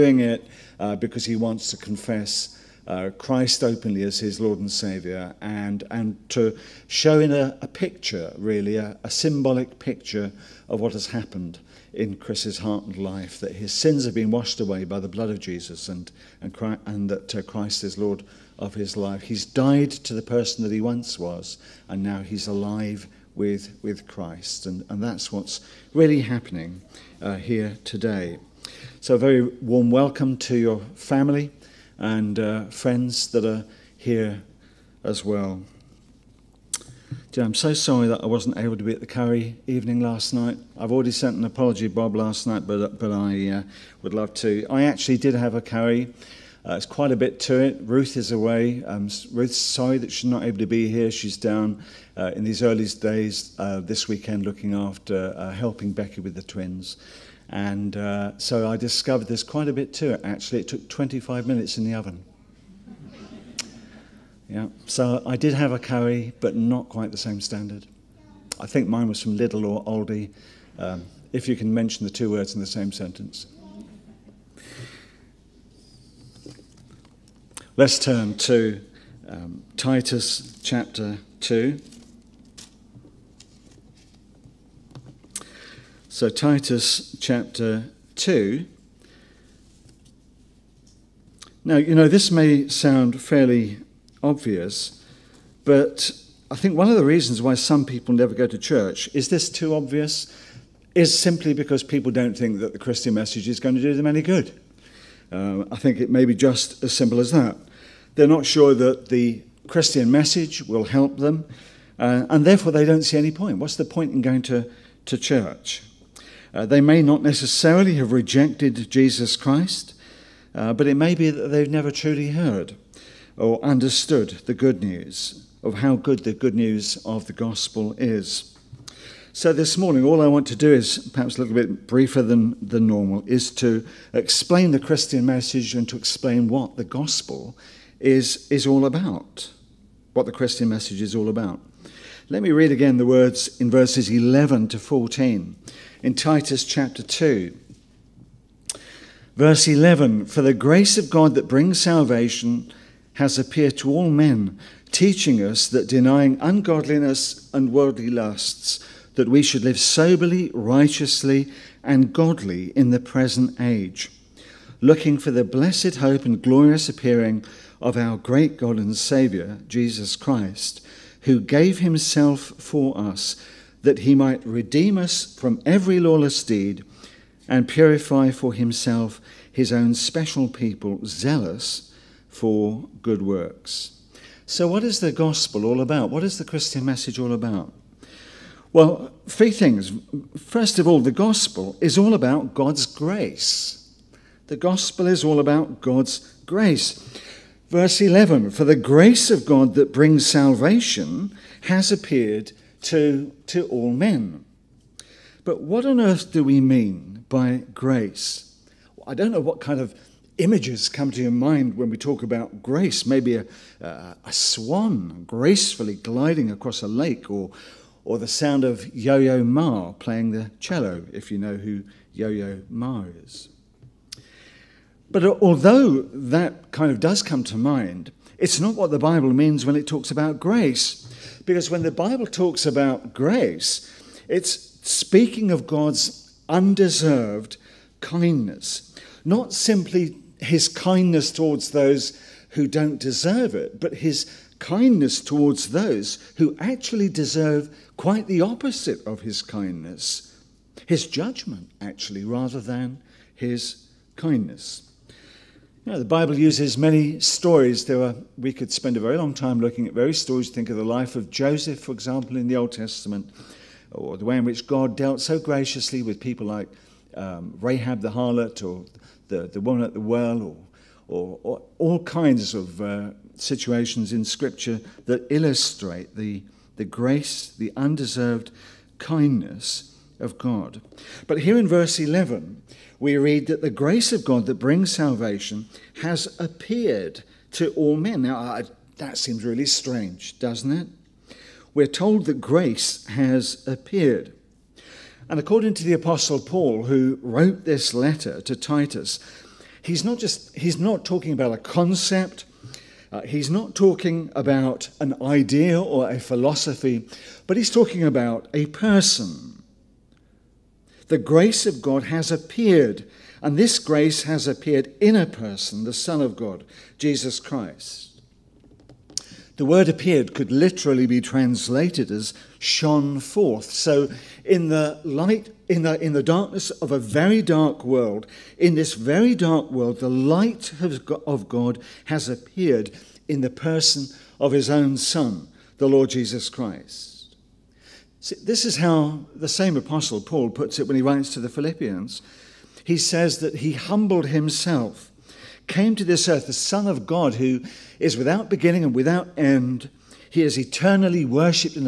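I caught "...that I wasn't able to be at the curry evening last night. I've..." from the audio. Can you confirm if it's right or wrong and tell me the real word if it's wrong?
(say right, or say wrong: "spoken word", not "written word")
right.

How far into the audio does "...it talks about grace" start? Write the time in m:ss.
3:49.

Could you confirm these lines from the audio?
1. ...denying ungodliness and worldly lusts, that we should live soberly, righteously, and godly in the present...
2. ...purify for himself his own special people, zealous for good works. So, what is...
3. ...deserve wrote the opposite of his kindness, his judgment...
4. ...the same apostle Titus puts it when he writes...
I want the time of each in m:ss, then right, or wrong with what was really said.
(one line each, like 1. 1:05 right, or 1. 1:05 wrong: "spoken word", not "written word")
1. 2:35 right
2. 2:57 right
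3. 4:07 wrong: "quite", not "wrote"
4. 5:39 wrong: "Paul", not "Titus".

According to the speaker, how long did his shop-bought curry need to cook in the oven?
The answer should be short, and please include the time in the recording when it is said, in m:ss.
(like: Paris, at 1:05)
25 minutes, at 1:00.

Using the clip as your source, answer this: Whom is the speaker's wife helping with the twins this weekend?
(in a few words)
Becky.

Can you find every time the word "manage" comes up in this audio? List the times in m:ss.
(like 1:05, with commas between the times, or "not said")
not said.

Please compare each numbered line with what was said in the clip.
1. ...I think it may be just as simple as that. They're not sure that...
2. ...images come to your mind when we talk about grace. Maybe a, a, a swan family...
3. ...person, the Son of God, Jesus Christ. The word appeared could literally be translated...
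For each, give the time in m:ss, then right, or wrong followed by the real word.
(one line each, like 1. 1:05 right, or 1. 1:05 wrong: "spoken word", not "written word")
1. 1:45 right
2. 3:30 wrong: "gracefully", not "family"
3. 5:15 right.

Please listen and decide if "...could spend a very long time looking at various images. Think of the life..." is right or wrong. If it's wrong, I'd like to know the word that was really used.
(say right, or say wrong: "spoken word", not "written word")
wrong: "stories", not "images".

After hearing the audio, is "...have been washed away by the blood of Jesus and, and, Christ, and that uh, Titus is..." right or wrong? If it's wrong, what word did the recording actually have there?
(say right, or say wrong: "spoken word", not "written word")
wrong: "Christ", not "Titus".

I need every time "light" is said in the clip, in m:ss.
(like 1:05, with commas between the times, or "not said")
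5:25, 5:30.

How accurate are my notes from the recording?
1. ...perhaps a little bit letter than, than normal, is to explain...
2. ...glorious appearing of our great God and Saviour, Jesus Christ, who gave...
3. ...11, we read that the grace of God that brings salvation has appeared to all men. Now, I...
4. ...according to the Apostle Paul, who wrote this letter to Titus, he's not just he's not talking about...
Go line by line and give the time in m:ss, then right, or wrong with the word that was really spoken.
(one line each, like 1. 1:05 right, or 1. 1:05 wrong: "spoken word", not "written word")
1. 2:11 wrong: "briefer", not "letter"
2. 2:46 right
3. 4:41 right
4. 4:55 right.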